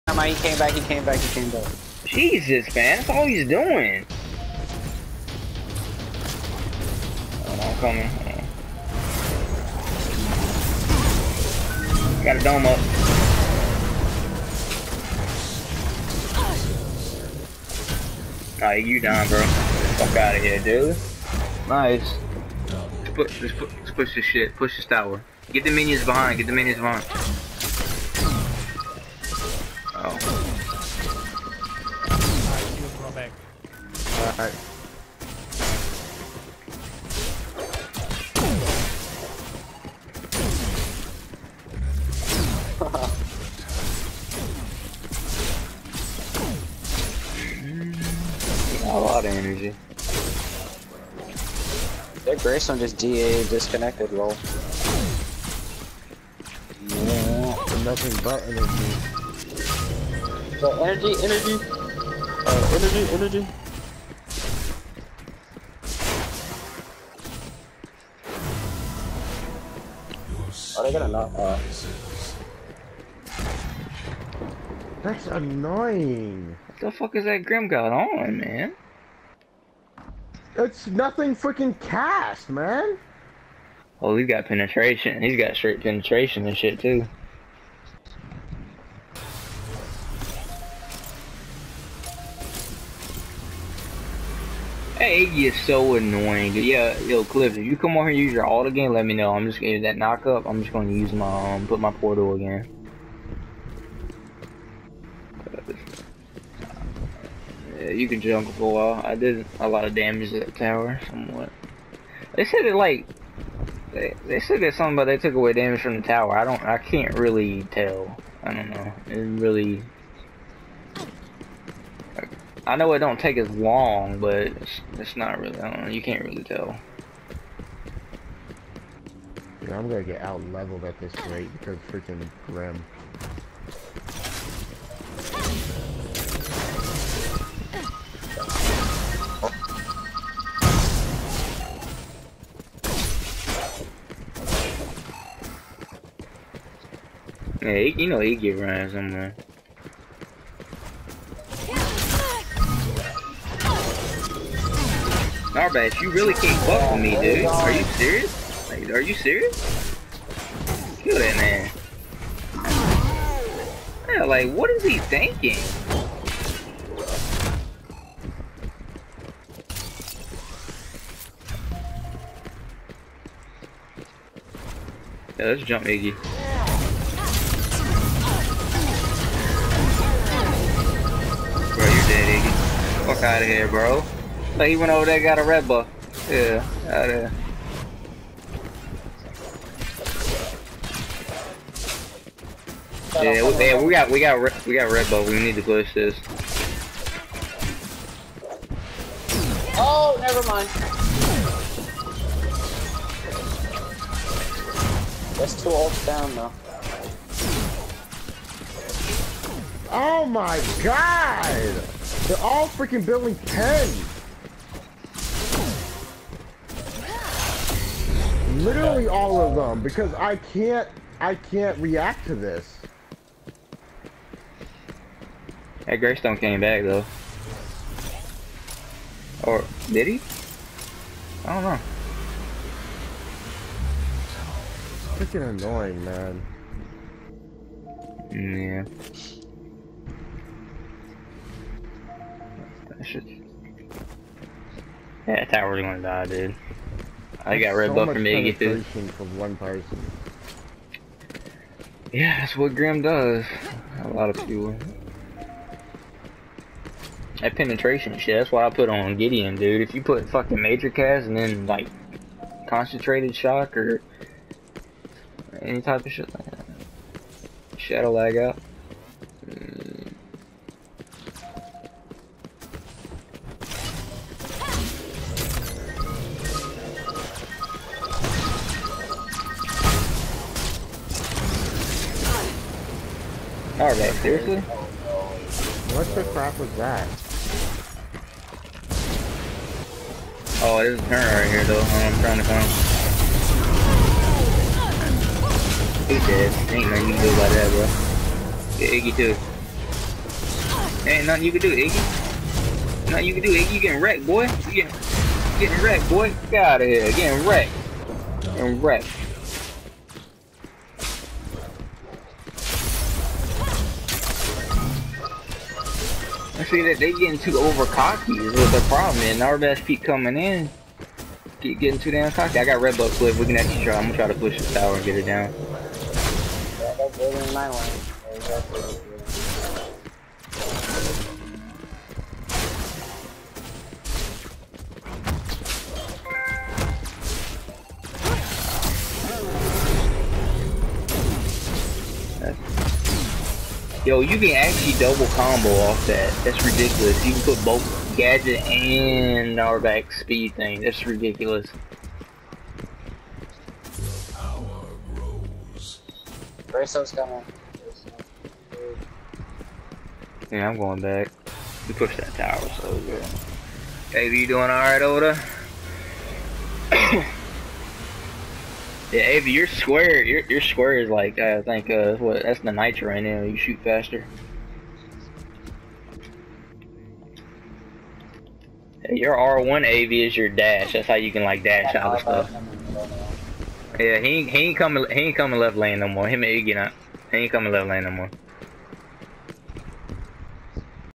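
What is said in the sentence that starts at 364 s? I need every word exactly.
Baby, you doing alright over there?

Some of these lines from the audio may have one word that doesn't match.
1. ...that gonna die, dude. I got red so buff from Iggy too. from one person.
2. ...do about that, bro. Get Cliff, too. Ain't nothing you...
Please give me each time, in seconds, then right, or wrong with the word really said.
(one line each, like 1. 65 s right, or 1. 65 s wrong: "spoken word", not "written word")
1. 245 s right
2. 297 s wrong: "Iggy", not "Cliff".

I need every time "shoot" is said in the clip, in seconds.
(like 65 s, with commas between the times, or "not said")
373 s.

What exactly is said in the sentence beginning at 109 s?
I did a lot of damage to that tower, somewhat.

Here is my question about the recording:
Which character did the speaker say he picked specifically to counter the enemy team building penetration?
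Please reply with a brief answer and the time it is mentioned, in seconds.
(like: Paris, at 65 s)
Gideon, at 259 s.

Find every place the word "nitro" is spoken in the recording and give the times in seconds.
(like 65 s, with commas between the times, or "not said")
372 s.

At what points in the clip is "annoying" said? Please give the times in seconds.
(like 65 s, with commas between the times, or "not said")
75 s, 95 s, 235 s.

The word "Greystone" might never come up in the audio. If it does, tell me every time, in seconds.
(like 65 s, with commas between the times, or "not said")
52 s, 225 s.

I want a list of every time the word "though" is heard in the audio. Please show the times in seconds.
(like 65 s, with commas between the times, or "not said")
206 s, 226 s, 291 s.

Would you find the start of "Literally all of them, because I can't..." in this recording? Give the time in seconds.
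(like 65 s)
218 s.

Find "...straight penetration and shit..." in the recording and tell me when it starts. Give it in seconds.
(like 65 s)
85 s.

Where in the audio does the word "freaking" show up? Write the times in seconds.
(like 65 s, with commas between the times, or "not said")
81 s, 131 s, 212 s, 235 s.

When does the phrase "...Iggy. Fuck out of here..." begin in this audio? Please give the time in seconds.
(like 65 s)
182 s.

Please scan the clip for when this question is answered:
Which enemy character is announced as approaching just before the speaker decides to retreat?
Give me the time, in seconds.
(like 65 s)
356 s.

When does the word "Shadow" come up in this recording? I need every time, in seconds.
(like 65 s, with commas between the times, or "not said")
267 s.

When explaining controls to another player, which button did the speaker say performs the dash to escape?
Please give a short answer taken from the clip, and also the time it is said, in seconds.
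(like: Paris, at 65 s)
R1, at 379 s.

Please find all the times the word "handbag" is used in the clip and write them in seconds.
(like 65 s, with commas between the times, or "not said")
not said.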